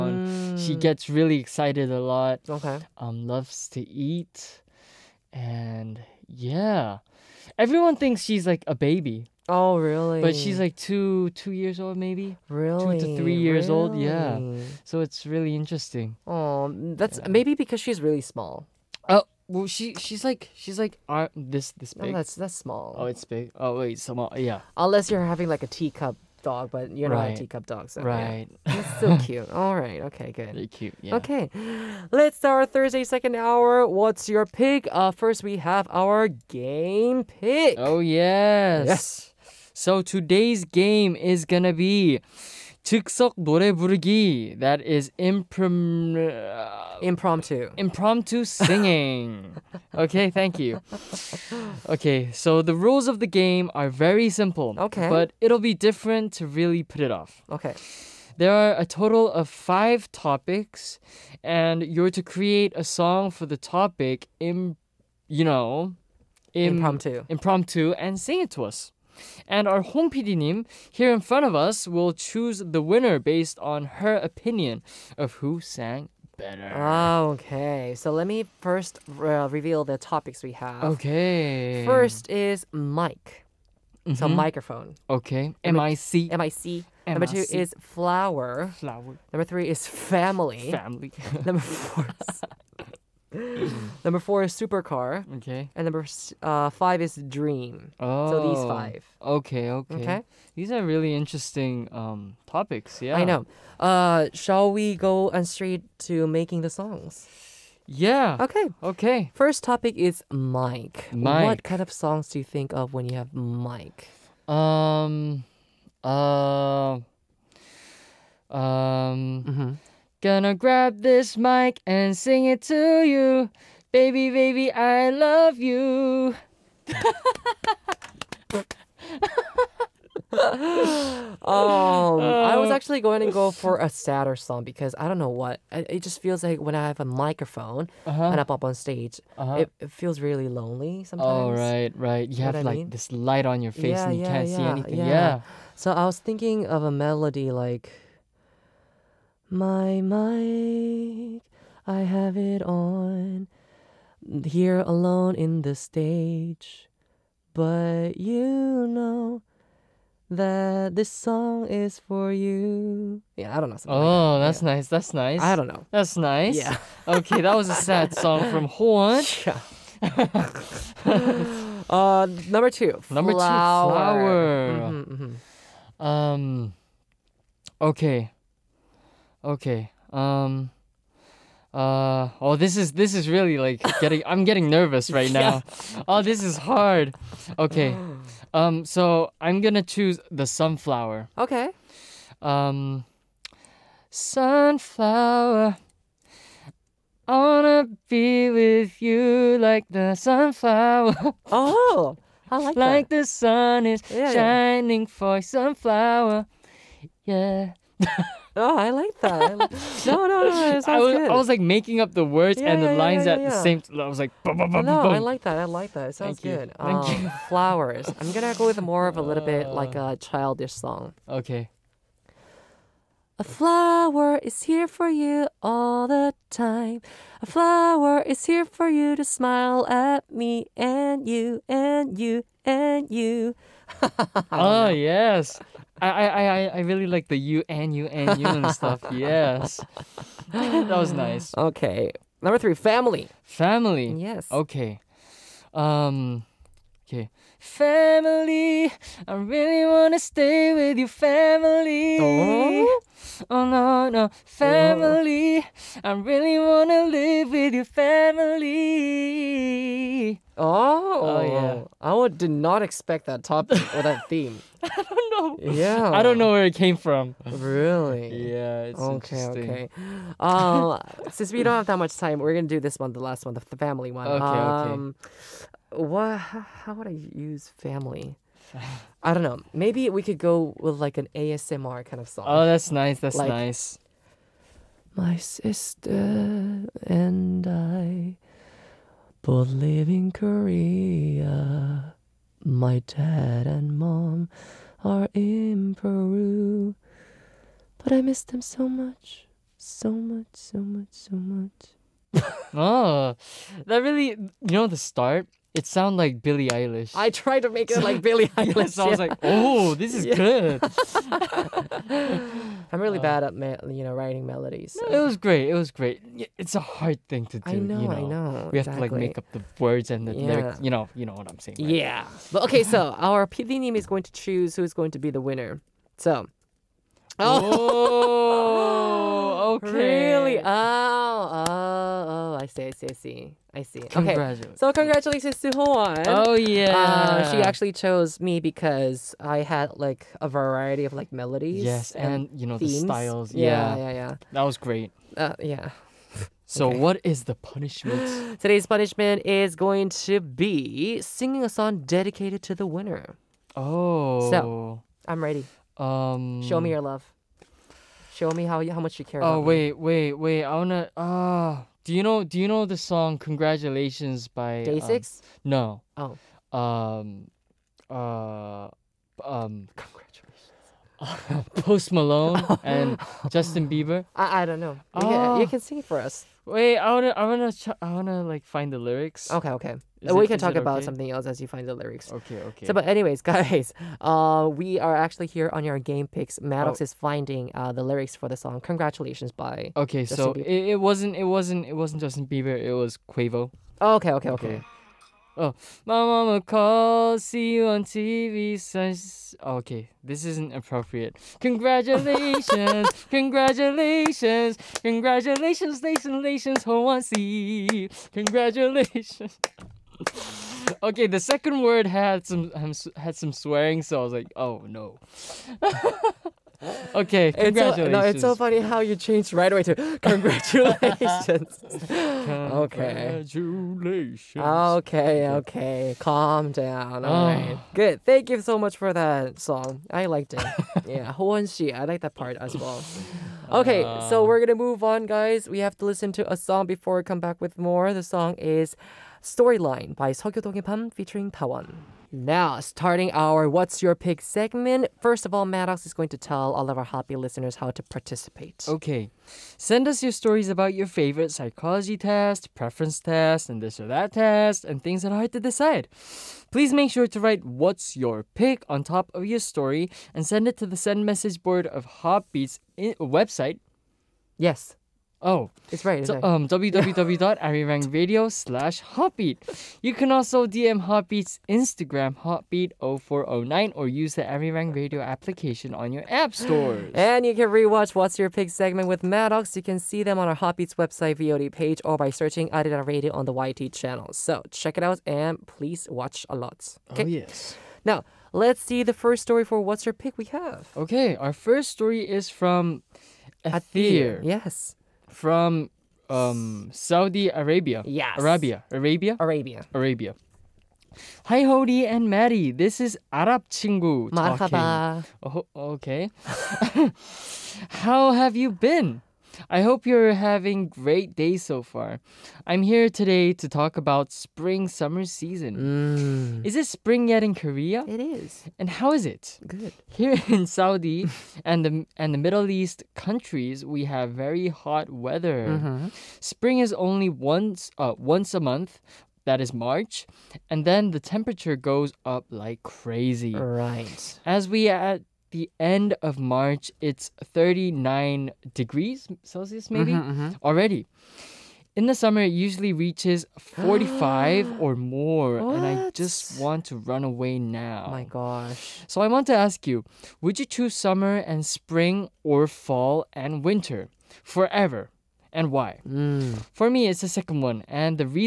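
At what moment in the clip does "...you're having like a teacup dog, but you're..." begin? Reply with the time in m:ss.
0:25.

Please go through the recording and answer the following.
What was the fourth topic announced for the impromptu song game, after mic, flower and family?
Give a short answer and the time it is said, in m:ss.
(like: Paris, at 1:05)
Supercar, at 1:34.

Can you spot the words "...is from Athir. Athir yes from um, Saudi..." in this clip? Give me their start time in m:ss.
8:12.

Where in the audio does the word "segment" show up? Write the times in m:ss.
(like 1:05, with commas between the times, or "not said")
7:24, 7:58.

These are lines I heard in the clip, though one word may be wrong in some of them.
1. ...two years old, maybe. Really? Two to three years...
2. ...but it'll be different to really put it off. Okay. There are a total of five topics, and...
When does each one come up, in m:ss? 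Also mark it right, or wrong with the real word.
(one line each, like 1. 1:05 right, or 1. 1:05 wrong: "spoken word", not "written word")
1. 0:11 right
2. 0:55 right.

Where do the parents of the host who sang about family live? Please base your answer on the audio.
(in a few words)
Peru.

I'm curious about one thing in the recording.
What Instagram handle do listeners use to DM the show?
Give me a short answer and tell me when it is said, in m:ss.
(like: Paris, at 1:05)
Hotbeat0409, at 7:52.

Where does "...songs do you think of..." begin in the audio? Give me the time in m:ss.
1:51.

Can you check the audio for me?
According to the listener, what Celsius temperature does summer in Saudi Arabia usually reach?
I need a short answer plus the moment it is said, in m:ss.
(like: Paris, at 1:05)
45, at 9:03.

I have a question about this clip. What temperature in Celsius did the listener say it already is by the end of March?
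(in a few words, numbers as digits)
39.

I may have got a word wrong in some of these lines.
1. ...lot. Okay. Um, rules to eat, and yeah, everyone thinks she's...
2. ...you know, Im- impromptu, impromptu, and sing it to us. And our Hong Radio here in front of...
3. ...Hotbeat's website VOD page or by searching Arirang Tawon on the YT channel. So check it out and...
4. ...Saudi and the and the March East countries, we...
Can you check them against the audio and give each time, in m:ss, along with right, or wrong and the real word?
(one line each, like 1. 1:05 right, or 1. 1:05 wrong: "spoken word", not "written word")
1. 0:01 wrong: "loves", not "rules"
2. 1:05 wrong: "Nim", not "Radio"
3. 8:00 wrong: "Radio", not "Tawon"
4. 8:40 wrong: "Middle", not "March".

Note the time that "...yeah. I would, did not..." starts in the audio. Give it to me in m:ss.
4:21.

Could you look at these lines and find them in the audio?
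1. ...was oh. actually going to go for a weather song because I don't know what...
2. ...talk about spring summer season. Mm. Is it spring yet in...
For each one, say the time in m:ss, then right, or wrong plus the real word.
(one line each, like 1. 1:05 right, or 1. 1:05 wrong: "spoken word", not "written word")
1. 2:12 wrong: "sadder", not "weather"
2. 8:33 right.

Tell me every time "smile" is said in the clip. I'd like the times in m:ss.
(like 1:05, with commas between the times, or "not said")
3:49.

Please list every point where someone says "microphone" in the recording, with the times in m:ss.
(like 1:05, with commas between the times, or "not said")
1:24, 2:17.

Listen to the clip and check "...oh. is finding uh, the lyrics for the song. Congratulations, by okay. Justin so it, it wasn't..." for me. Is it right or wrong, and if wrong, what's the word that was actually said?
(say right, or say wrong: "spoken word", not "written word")
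right.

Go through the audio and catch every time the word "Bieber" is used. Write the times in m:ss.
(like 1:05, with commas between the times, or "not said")
6:13, 6:32.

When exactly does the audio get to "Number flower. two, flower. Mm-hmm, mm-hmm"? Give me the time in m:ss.
2:53.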